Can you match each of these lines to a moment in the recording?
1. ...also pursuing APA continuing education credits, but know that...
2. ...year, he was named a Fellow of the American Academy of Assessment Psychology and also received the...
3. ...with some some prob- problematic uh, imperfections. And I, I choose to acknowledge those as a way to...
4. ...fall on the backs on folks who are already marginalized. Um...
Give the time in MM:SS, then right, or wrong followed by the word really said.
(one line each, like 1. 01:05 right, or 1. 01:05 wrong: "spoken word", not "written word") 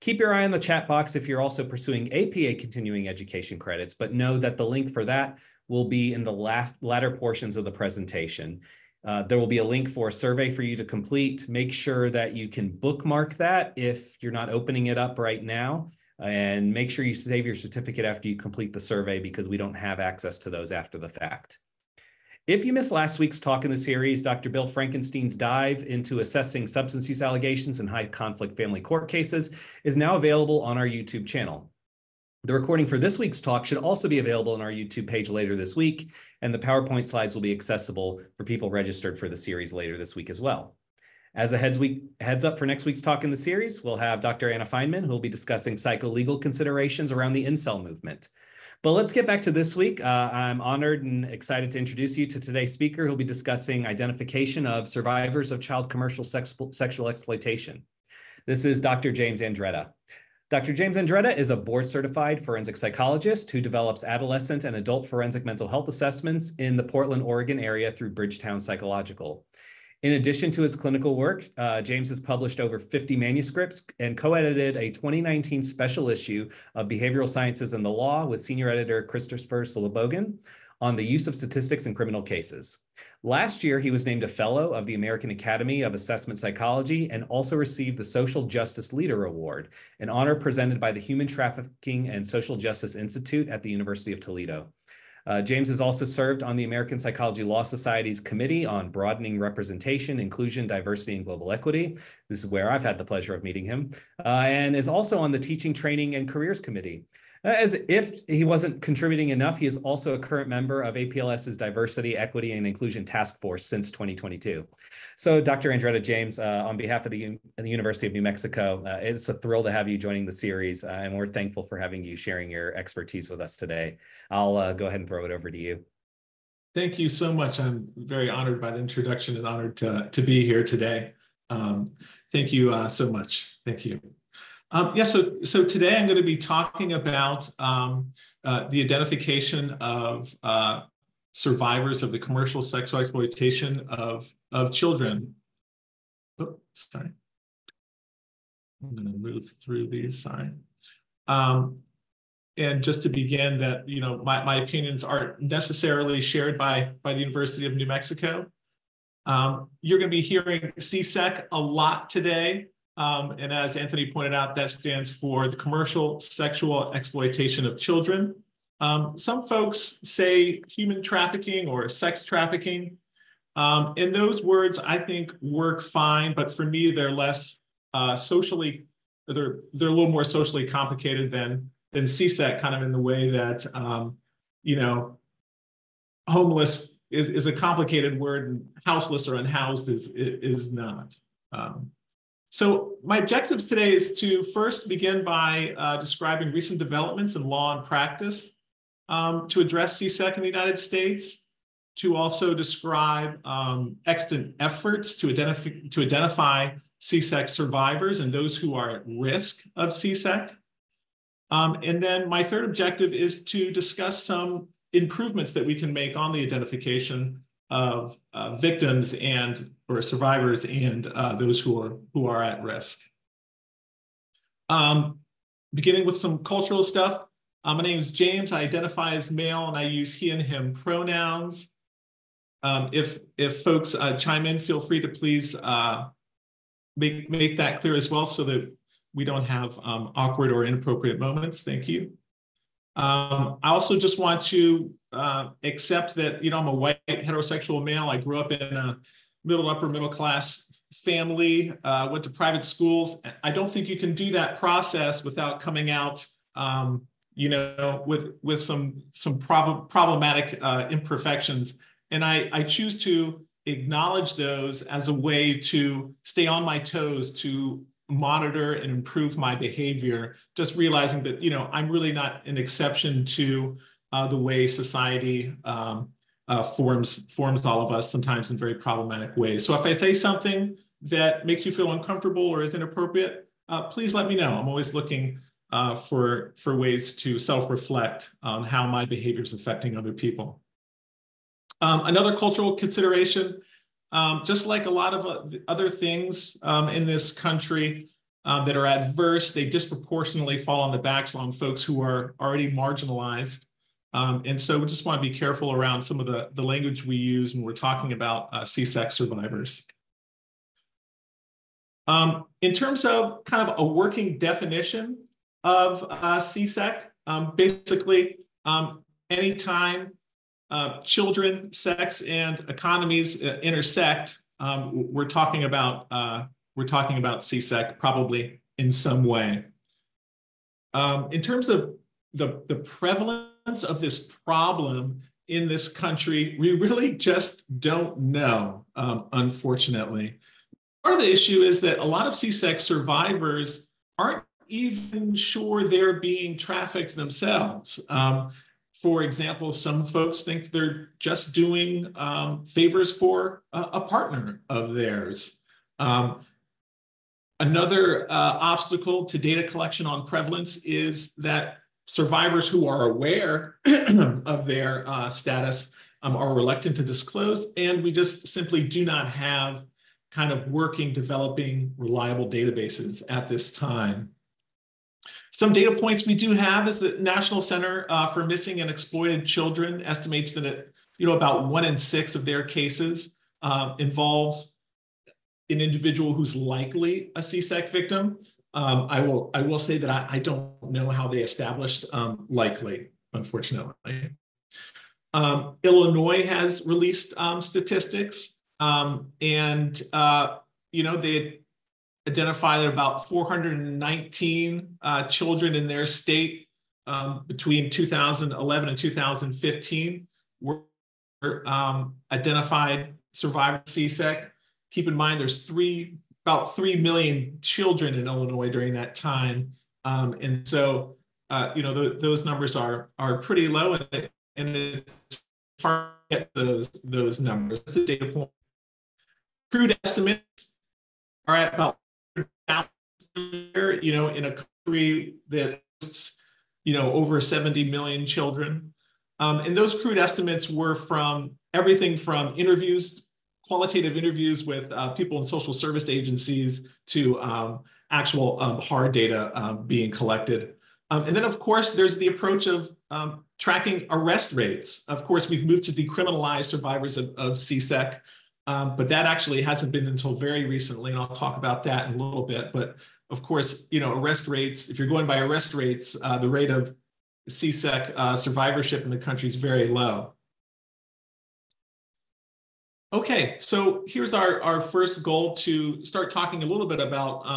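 1. 00:01 right
2. 01:23 right
3. 04:18 right
4. 05:00 right.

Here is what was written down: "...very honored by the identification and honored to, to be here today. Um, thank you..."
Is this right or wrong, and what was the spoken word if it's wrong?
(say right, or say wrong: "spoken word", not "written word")
wrong: "introduction", not "identification".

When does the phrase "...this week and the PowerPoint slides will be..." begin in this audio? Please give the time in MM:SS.
00:35.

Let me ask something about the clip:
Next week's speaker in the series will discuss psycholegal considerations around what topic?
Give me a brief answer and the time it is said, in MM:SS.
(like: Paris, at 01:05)
the incel movement, at 00:47.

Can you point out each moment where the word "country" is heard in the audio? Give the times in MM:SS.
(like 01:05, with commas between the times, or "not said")
04:57, 05:35, 07:14, 07:49.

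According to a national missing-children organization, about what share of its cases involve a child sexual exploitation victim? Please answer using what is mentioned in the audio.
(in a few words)
1 in 6.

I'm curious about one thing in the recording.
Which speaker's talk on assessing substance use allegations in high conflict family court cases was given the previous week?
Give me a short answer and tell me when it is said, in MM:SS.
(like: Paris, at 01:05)
Dr. Bill Frankenstein, at 00:24.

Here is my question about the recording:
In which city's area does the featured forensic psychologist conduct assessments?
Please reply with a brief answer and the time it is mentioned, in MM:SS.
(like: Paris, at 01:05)
Portland, Oregon, at 01:06.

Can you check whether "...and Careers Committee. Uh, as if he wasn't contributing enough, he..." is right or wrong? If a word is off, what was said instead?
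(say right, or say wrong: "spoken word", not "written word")
right.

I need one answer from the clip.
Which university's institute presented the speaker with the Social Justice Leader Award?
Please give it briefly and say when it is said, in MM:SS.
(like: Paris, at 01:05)
University of Toledo, at 01:33.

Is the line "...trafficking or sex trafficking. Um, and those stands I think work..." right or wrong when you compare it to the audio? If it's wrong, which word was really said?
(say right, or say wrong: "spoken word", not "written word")
wrong: "words", not "stands".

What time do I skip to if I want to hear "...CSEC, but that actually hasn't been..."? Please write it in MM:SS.
07:37.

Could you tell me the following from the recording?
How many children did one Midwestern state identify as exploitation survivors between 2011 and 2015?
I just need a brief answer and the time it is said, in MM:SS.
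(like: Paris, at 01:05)
419, at 06:43.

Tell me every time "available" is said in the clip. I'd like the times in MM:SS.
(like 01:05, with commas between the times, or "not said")
00:30, 00:34.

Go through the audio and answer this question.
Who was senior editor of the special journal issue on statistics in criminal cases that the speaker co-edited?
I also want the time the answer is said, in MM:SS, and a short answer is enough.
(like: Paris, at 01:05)
Christopher Slobogin, at 01:19.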